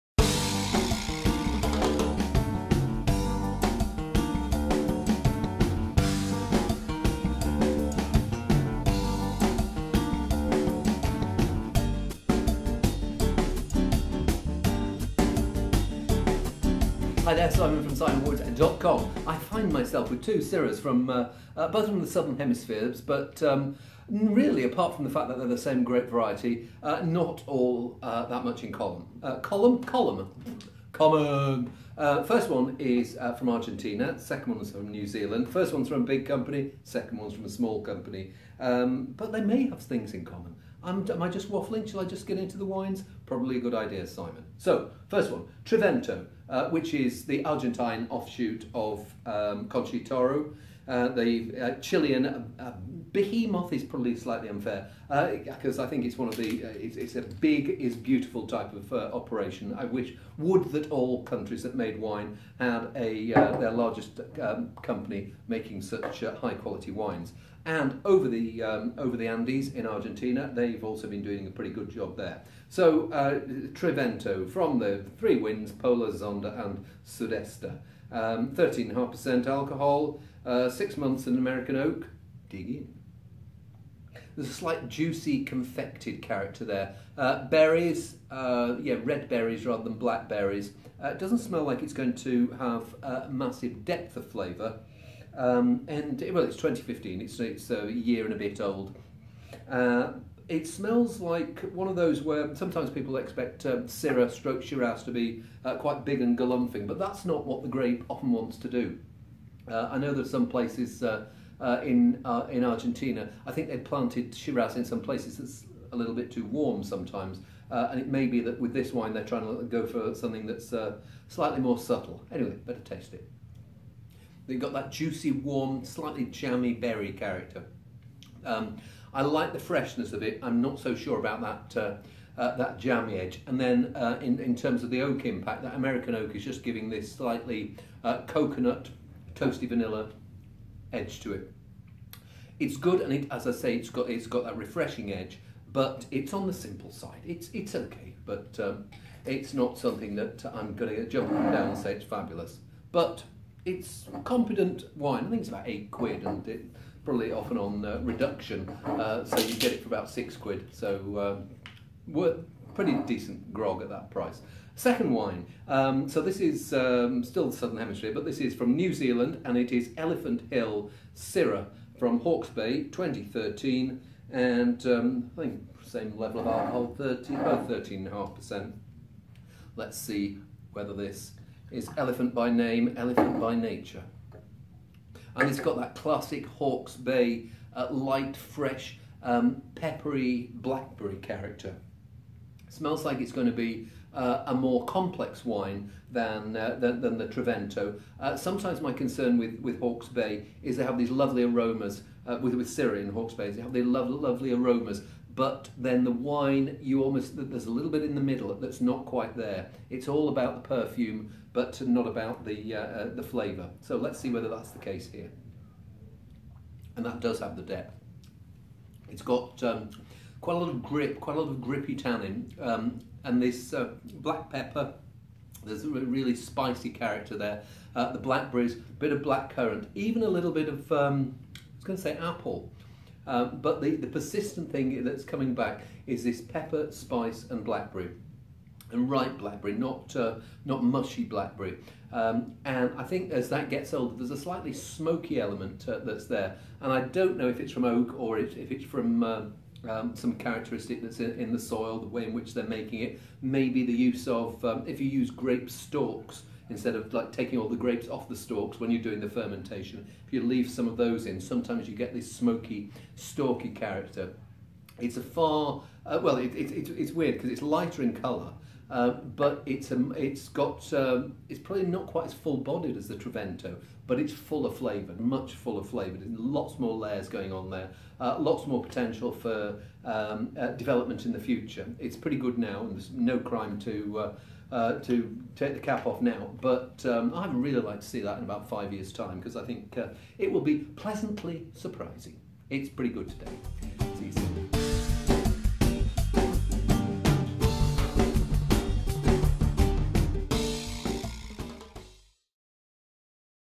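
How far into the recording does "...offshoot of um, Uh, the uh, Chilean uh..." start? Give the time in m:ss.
0:48.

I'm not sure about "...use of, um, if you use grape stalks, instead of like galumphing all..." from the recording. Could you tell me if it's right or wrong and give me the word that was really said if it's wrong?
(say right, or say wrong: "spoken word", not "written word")
wrong: "taking", not "galumphing".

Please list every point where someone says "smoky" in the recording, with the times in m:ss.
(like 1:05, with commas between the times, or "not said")
4:04, 4:22.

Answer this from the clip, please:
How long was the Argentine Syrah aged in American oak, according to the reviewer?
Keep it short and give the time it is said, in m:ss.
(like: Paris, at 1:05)
6 months, at 1:20.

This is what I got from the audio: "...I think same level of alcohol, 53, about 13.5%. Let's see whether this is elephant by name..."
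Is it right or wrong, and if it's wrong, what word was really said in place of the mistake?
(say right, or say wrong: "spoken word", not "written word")
wrong: "13", not "53".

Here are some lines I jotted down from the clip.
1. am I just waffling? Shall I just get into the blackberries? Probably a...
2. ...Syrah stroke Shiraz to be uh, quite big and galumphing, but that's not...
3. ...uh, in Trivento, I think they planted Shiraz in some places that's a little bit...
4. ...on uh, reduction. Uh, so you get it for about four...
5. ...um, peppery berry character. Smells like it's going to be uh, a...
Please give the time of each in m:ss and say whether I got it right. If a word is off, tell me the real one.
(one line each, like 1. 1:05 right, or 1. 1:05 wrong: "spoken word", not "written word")
1. 0:40 wrong: "wines", not "blackberries"
2. 1:43 right
3. 1:52 wrong: "Argentina", not "Trivento"
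4. 2:37 wrong: "six", not "four"
5. 3:09 wrong: "blackberry", not "berry".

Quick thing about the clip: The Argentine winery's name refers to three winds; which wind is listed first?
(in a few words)
Polar.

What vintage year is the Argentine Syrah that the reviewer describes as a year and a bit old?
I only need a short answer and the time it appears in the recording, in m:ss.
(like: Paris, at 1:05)
2015, at 1:36.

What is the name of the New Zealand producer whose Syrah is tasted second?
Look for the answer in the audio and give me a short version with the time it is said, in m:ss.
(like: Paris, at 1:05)
Elephant Hill, at 2:49.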